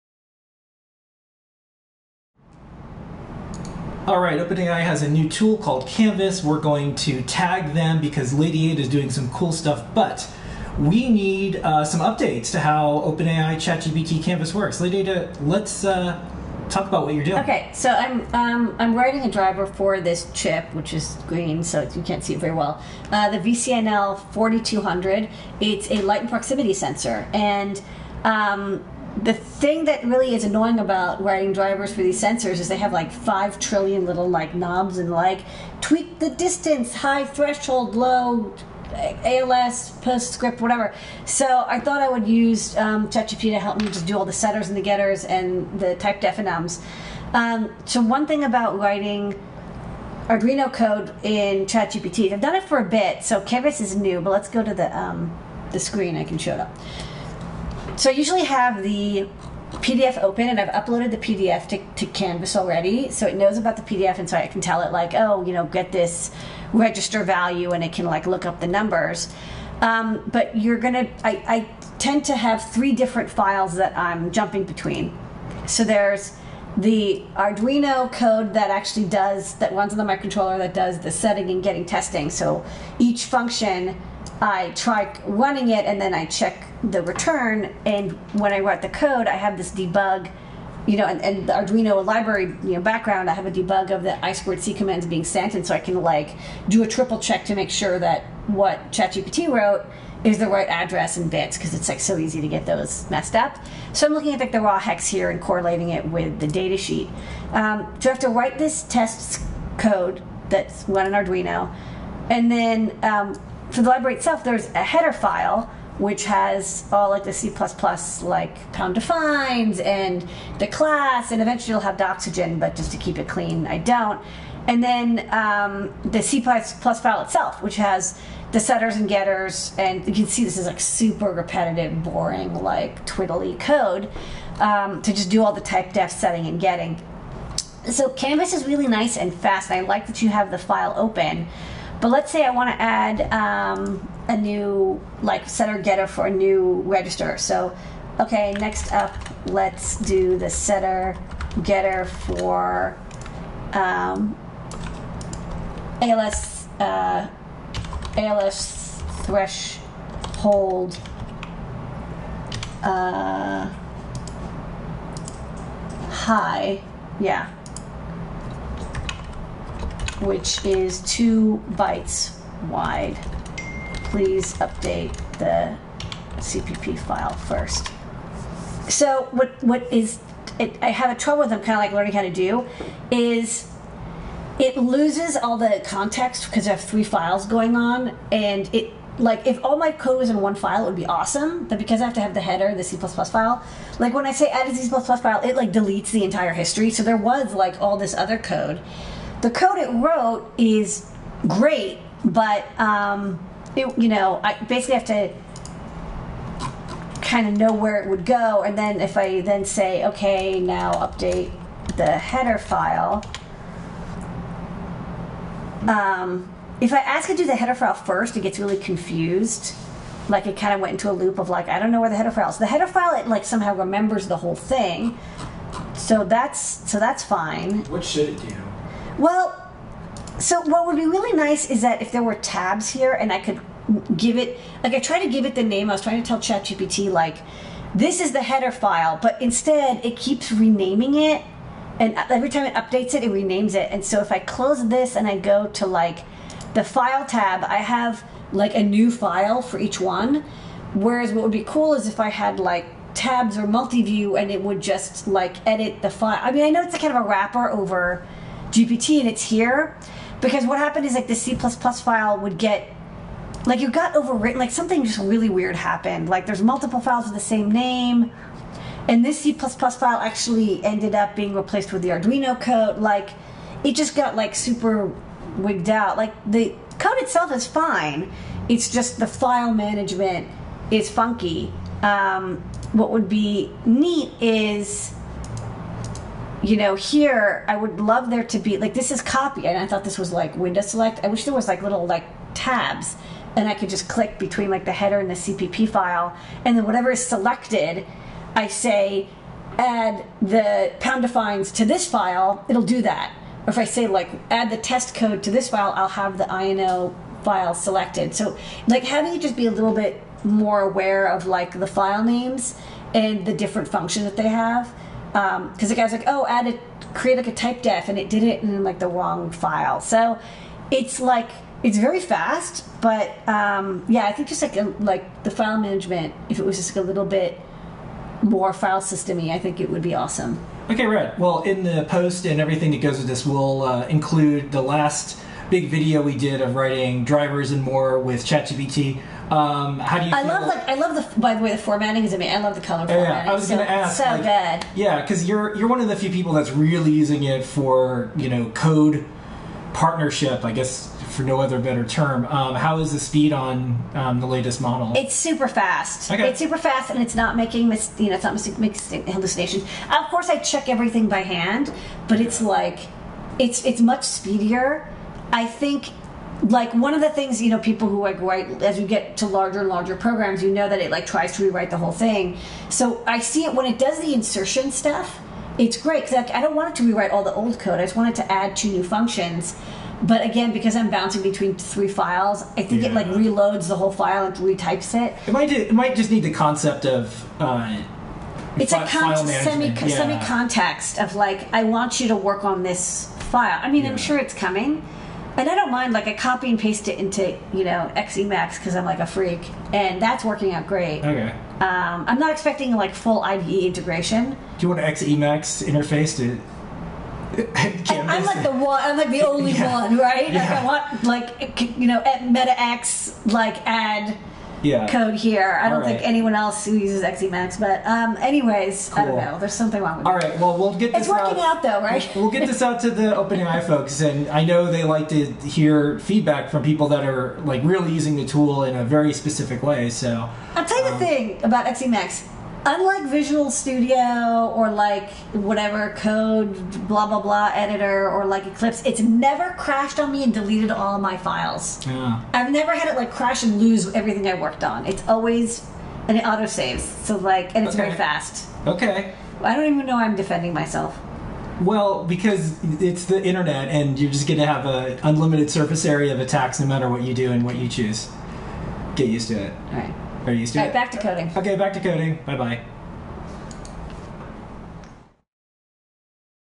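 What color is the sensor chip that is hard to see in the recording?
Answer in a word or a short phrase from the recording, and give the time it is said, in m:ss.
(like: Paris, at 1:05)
green, at 0:21.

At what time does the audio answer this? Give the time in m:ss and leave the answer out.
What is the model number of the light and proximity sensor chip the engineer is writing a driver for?
0:23.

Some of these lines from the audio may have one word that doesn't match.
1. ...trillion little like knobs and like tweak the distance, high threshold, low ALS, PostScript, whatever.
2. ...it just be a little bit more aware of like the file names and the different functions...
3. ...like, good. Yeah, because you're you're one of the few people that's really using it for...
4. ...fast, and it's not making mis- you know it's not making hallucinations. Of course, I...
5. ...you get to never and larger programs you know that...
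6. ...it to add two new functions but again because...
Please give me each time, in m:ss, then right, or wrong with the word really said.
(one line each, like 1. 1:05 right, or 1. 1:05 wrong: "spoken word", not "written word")
1. 0:33 right
2. 5:09 right
3. 5:44 right
4. 5:56 right
5. 6:08 wrong: "larger", not "never"
6. 6:18 right.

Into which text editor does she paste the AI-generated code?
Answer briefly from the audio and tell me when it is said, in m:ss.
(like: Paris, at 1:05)
Emacs, at 6:38.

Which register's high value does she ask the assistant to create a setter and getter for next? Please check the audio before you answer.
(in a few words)
ALS threshold.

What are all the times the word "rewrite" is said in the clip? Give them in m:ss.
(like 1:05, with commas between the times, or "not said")
6:11, 6:17.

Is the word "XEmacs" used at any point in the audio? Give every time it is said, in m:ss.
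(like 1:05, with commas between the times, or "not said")
6:57, 7:11.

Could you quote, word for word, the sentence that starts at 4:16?
I mean, I know it's a kind of a wrapper over GPT and it's here.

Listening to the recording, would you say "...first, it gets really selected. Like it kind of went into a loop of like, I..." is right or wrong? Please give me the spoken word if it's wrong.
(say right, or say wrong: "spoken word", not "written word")
wrong: "confused", not "selected".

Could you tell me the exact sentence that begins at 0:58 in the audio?
So I usually have the PDF open and I've uploaded the PDF to, to Canvas already.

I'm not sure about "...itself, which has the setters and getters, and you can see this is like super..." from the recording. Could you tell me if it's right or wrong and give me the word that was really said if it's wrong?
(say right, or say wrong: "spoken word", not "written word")
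right.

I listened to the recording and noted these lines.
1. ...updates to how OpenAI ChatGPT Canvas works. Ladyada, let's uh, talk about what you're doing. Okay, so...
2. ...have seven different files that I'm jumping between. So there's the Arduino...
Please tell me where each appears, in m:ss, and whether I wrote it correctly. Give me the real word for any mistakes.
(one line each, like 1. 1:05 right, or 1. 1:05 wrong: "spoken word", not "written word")
1. 0:11 right
2. 1:12 wrong: "three", not "seven".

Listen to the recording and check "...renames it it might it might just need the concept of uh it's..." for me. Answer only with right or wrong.
wrong.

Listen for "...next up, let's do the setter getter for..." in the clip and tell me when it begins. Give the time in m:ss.
2:28.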